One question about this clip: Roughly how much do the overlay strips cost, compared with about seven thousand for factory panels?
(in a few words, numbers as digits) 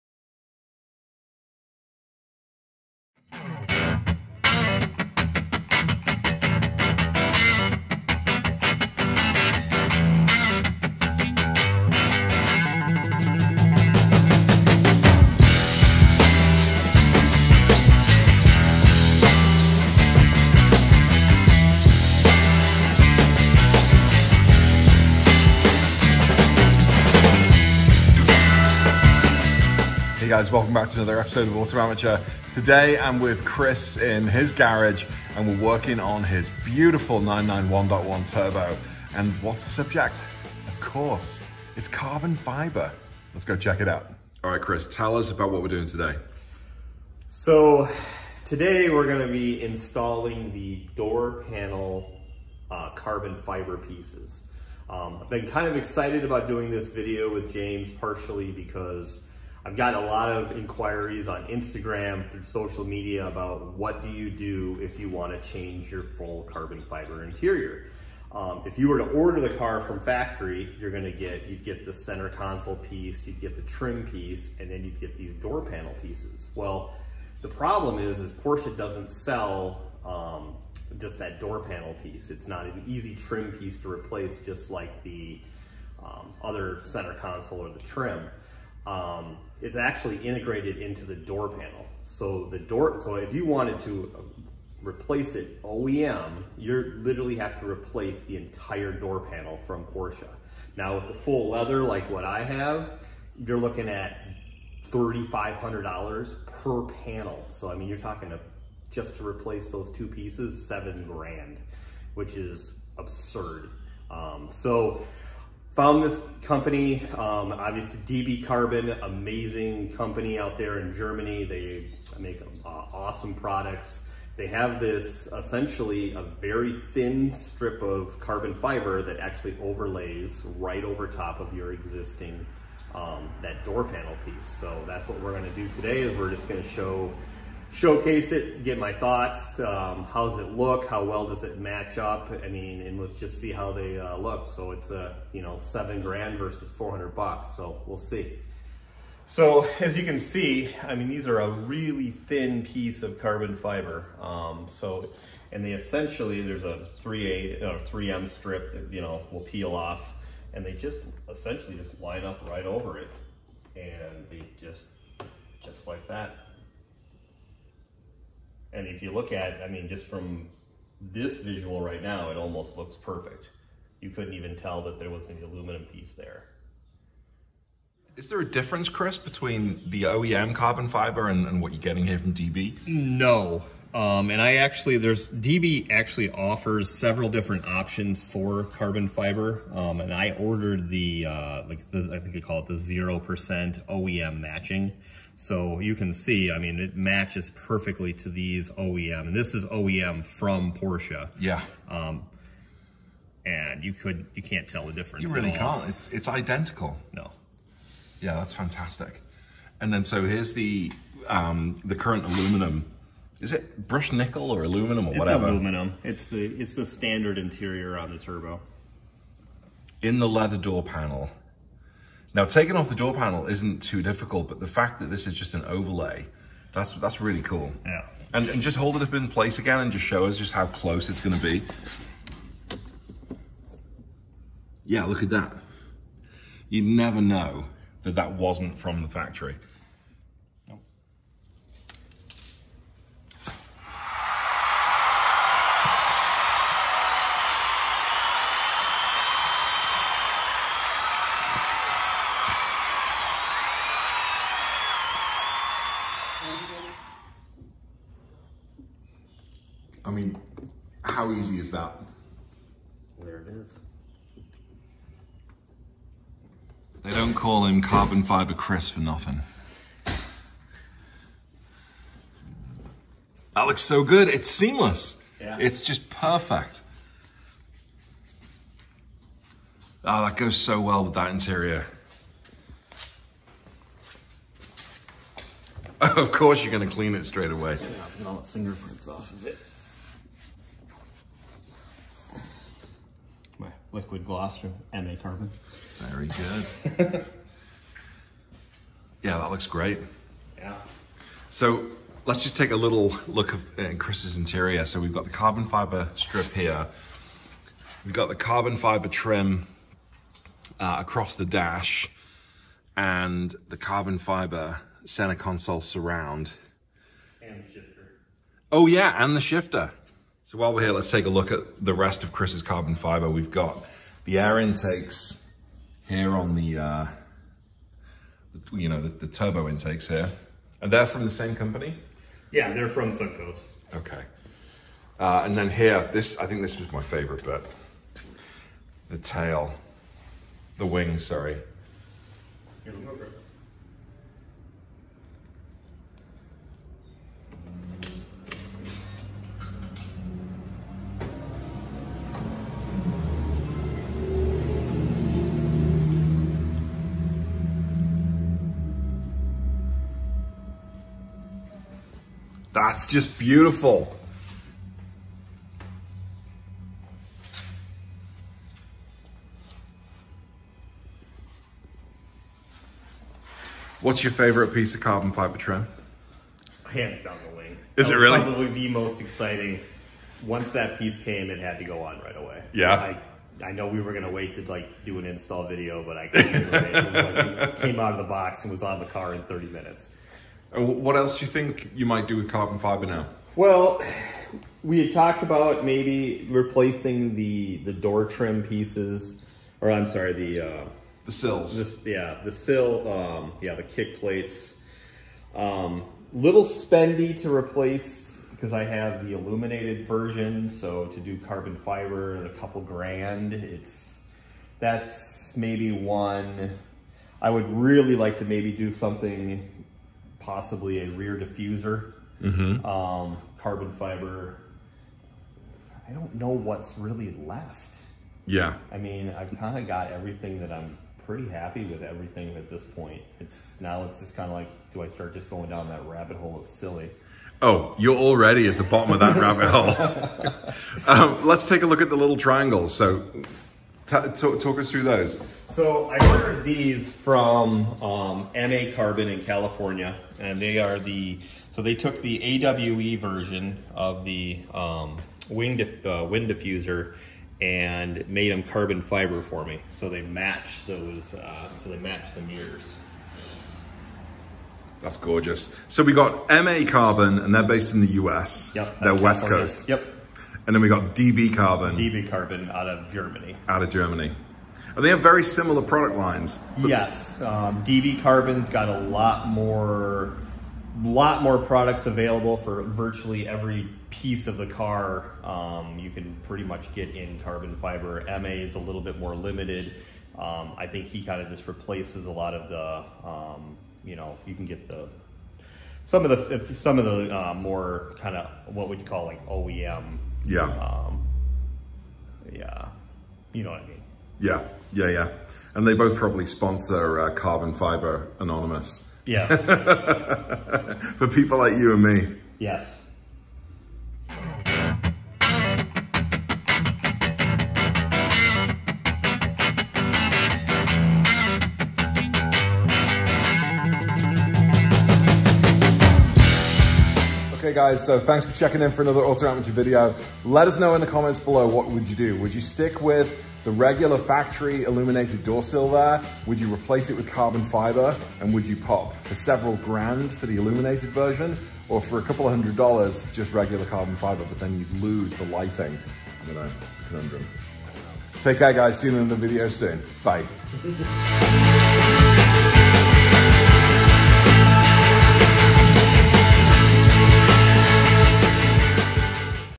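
$400.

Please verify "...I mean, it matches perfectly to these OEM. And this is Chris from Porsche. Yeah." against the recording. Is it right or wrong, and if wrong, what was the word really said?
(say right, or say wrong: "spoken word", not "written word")
wrong: "OEM", not "Chris".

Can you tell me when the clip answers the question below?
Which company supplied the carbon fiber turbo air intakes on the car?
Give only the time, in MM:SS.
05:33.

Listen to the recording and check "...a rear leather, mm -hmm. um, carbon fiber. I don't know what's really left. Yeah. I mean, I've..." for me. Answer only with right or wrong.
wrong.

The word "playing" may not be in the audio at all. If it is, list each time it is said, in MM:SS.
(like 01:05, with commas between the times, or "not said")
not said.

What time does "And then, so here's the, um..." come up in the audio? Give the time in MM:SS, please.
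03:29.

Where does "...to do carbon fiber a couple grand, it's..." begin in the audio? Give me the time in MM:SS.
06:51.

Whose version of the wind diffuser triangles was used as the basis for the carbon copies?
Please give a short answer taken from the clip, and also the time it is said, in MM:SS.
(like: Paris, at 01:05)
AWE, at 07:32.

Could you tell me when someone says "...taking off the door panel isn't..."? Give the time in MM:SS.
03:42.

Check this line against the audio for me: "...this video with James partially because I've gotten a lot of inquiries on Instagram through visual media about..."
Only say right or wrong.
wrong.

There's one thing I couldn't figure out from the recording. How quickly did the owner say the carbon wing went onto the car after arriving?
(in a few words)
30 minutes.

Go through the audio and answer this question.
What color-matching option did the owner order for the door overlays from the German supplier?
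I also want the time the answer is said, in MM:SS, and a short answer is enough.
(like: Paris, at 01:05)
0% OEM matching, at 03:12.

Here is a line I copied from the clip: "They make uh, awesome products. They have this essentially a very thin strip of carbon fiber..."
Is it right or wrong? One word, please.
right.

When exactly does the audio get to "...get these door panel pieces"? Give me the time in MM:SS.
01:15.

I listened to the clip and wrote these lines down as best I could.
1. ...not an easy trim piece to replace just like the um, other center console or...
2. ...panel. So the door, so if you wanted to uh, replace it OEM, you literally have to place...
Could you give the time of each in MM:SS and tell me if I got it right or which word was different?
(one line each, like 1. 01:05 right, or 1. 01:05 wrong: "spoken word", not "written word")
1. 01:22 right
2. 01:31 wrong: "replace", not "place".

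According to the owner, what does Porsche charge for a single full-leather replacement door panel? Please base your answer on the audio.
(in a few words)
$3,500.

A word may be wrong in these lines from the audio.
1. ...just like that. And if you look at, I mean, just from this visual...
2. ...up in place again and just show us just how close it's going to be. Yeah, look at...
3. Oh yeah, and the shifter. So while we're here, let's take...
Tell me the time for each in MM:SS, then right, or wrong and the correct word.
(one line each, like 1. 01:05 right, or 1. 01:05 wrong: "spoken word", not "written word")
1. 02:45 right
2. 03:49 right
3. 05:18 right.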